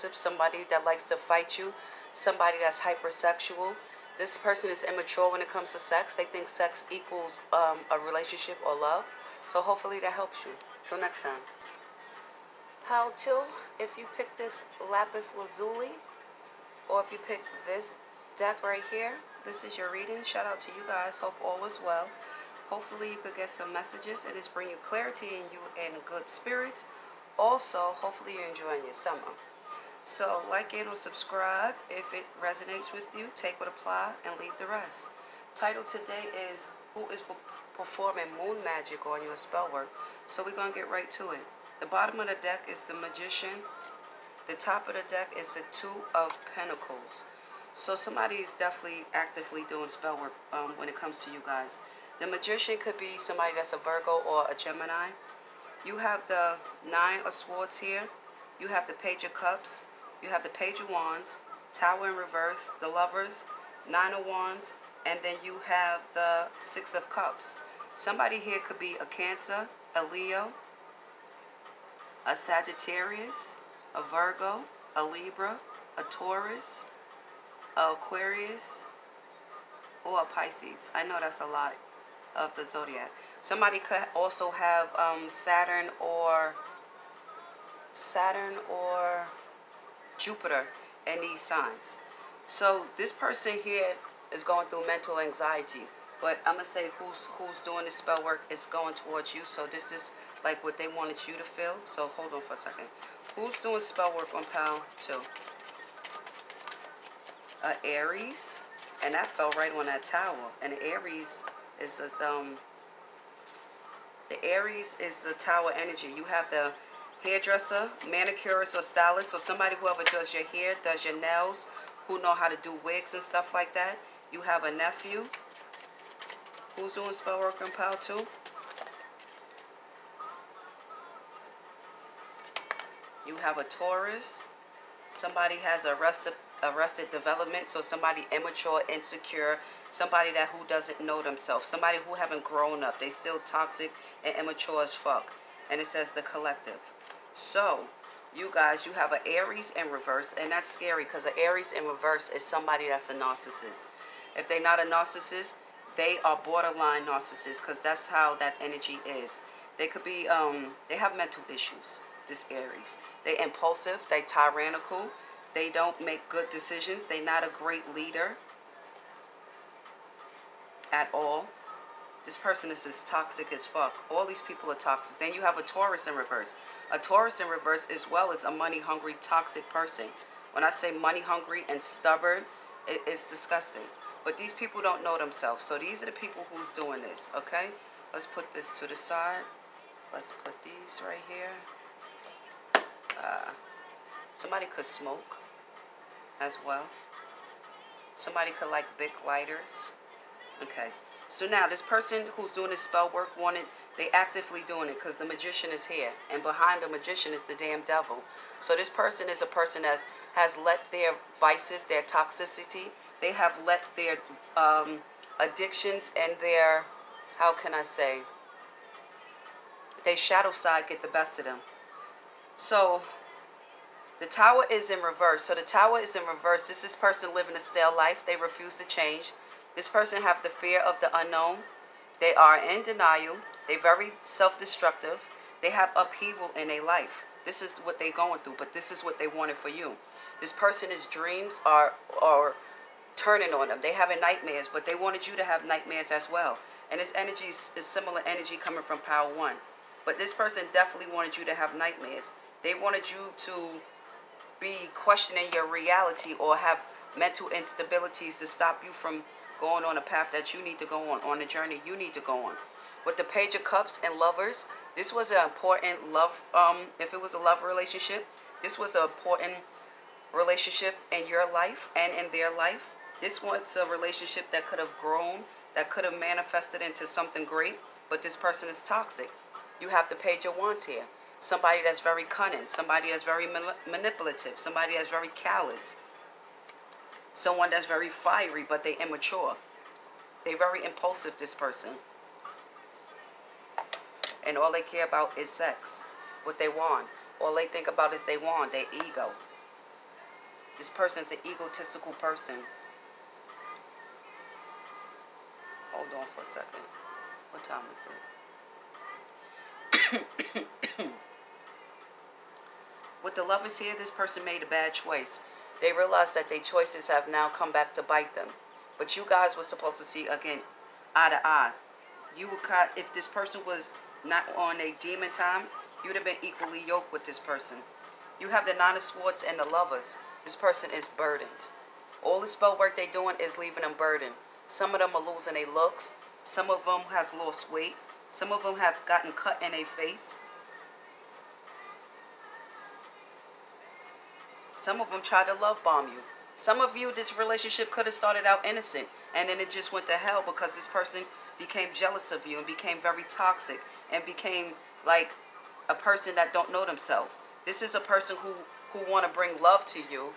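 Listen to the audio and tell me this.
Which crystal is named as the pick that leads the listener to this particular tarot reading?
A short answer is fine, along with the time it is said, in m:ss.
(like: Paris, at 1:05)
Lapis lazuli, at 0:14.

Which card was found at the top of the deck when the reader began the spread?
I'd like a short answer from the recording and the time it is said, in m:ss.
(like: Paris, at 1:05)
Two of Pentacles, at 0:45.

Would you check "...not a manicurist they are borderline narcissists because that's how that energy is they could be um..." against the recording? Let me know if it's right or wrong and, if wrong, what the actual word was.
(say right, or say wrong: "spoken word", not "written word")
wrong: "narcissist", not "manicurist".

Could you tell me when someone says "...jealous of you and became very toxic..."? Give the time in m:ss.
5:51.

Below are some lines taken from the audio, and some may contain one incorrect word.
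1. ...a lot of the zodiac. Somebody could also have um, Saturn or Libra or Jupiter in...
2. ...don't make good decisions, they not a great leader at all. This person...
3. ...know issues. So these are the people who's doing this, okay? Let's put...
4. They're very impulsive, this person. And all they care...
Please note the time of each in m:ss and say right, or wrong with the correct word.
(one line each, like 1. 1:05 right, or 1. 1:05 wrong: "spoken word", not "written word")
1. 1:21 wrong: "Saturn", not "Libra"
2. 2:45 right
3. 3:05 wrong: "themselves", not "issues"
4. 4:50 right.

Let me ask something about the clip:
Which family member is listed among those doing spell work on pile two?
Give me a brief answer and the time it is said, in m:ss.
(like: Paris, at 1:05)
Nephew, at 2:04.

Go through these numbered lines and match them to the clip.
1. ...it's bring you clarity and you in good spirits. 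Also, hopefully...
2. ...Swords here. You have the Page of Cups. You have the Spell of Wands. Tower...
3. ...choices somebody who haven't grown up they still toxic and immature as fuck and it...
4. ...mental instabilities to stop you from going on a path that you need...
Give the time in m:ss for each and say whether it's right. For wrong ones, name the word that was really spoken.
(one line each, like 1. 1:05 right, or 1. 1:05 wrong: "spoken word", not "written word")
1. 0:24 right
2. 0:57 wrong: "Page", not "Spell"
3. 2:21 wrong: "themselves", not "choices"
4. 4:17 right.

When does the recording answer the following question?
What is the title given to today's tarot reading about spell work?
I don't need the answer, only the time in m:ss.
0:36.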